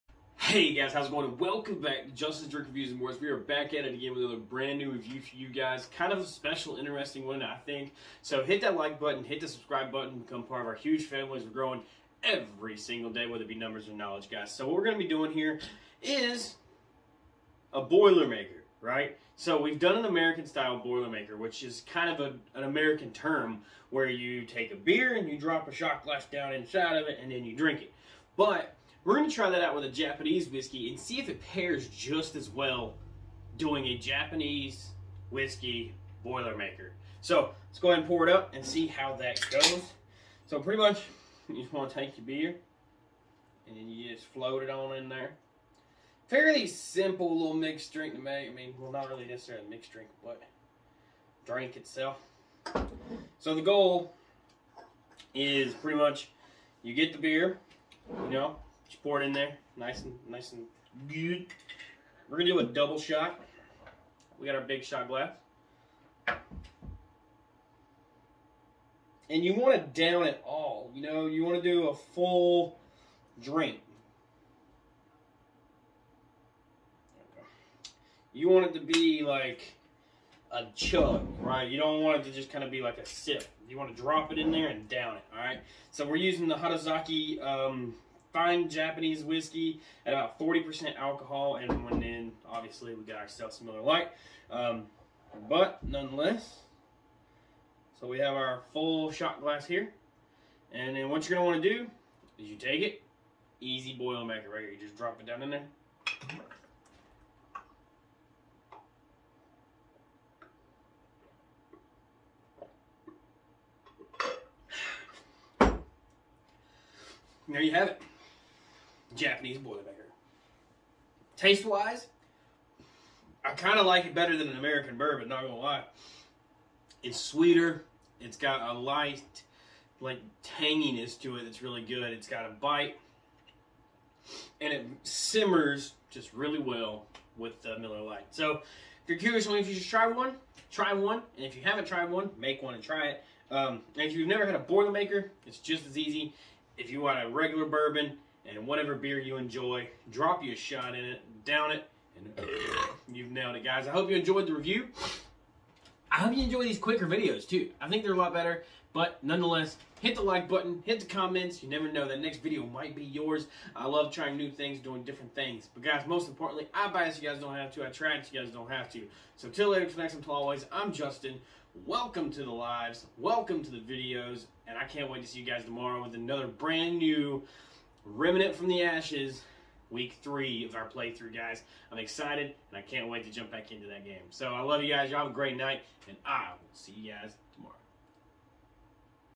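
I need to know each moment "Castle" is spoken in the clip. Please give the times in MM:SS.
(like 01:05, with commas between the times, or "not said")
not said.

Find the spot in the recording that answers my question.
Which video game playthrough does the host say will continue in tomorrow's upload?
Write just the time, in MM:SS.
02:58.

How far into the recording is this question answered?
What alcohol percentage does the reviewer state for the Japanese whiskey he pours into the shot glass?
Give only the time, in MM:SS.
01:30.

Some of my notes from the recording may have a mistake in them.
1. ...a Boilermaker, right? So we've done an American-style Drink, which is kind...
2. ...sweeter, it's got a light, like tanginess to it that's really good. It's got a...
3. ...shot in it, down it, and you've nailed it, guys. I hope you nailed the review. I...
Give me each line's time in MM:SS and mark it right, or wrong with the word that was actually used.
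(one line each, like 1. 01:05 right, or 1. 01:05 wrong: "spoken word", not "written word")
1. 00:17 wrong: "Boilermaker", not "Drink"
2. 02:07 right
3. 02:30 wrong: "enjoyed", not "nailed".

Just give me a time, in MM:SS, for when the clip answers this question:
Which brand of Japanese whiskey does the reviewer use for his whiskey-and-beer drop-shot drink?
01:26.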